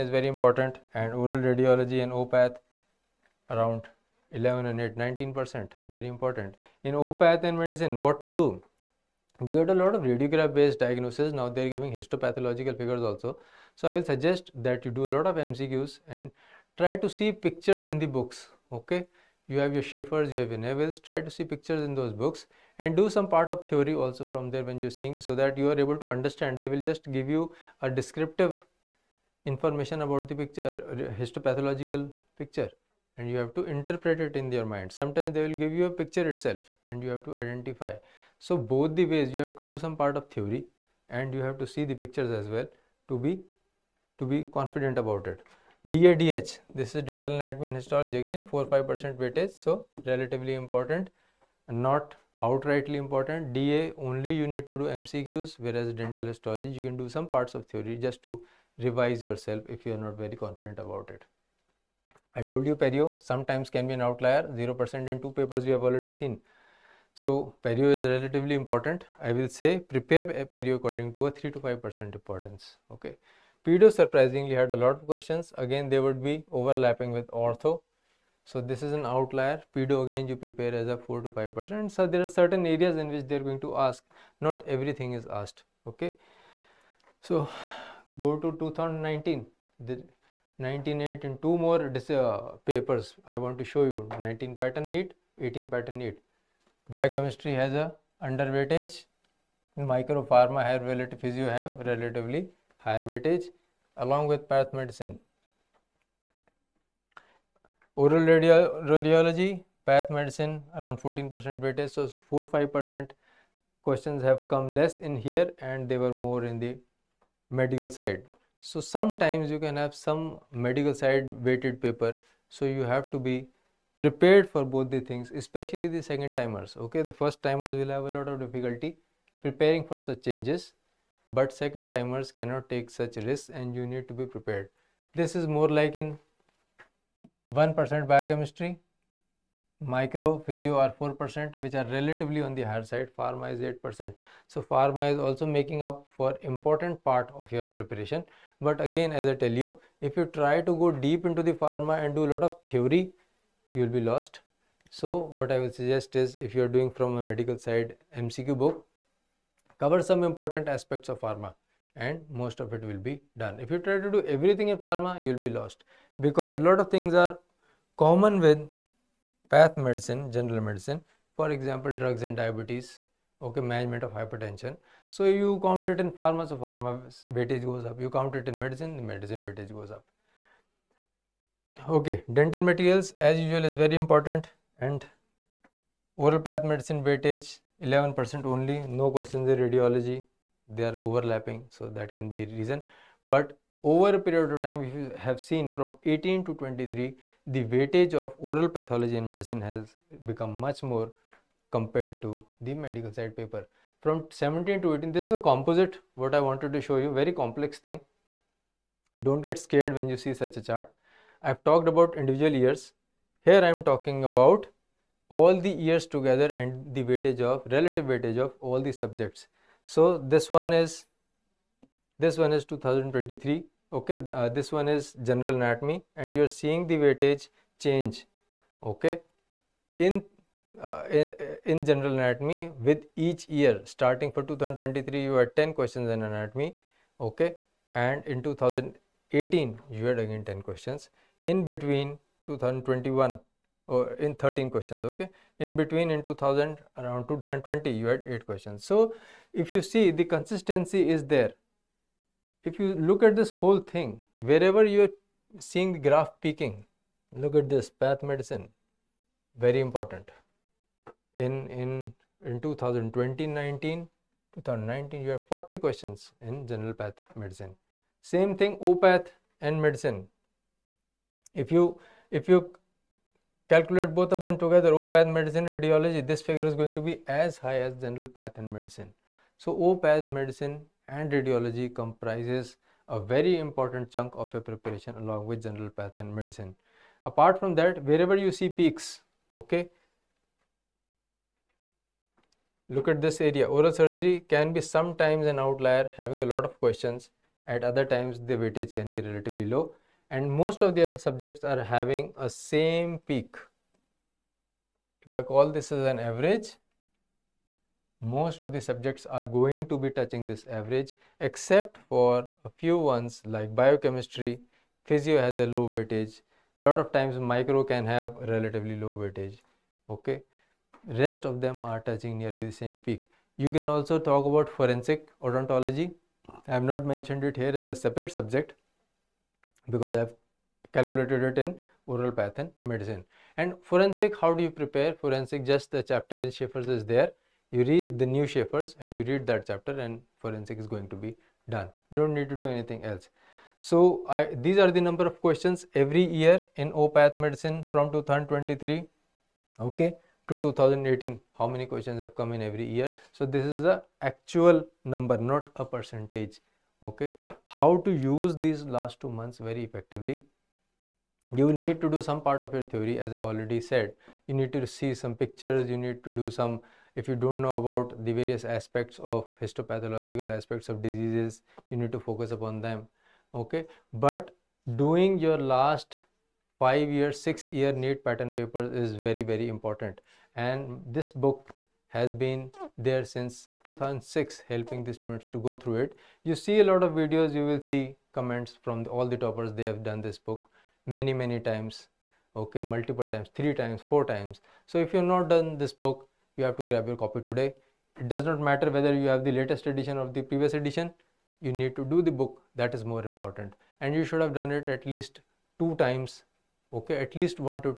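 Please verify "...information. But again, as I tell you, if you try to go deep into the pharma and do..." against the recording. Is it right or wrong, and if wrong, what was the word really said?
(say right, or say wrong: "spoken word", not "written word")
wrong: "preparation", not "information".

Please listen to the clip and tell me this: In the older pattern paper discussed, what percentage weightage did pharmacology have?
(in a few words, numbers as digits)
8%.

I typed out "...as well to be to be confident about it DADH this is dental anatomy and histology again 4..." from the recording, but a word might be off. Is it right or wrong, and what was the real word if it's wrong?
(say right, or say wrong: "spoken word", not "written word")
right.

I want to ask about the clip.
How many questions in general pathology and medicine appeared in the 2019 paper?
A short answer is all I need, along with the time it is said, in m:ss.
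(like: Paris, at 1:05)
40, at 4:25.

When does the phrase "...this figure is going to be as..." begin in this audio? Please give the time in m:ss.
4:36.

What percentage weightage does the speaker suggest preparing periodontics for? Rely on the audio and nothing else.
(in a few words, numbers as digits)
3 to 5%.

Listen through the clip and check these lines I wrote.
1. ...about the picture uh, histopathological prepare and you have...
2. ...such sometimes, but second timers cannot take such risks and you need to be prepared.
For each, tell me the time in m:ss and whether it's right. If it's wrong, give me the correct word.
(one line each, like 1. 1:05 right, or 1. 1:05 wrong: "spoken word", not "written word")
1. 0:30 wrong: "picture", not "prepare"
2. 2:09 wrong: "changes", not "sometimes".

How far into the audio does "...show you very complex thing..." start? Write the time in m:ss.
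3:26.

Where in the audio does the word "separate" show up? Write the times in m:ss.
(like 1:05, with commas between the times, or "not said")
5:27.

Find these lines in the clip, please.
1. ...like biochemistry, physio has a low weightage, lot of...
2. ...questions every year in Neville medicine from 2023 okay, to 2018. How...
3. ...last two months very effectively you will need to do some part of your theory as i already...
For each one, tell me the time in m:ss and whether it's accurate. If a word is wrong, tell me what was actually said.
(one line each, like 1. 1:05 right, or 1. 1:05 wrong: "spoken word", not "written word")
1. 5:13 right
2. 5:45 wrong: "OPath", not "Neville"
3. 5:58 right.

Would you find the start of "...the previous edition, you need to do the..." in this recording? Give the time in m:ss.
6:40.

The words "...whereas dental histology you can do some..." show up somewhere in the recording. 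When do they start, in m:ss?
0:55.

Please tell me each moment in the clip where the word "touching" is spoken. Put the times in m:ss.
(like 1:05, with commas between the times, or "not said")
5:10, 5:21.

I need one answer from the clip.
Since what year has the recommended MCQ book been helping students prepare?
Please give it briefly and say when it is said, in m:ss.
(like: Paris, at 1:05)
2006, at 6:23.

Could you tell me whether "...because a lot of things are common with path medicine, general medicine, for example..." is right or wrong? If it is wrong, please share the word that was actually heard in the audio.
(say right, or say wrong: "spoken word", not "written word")
right.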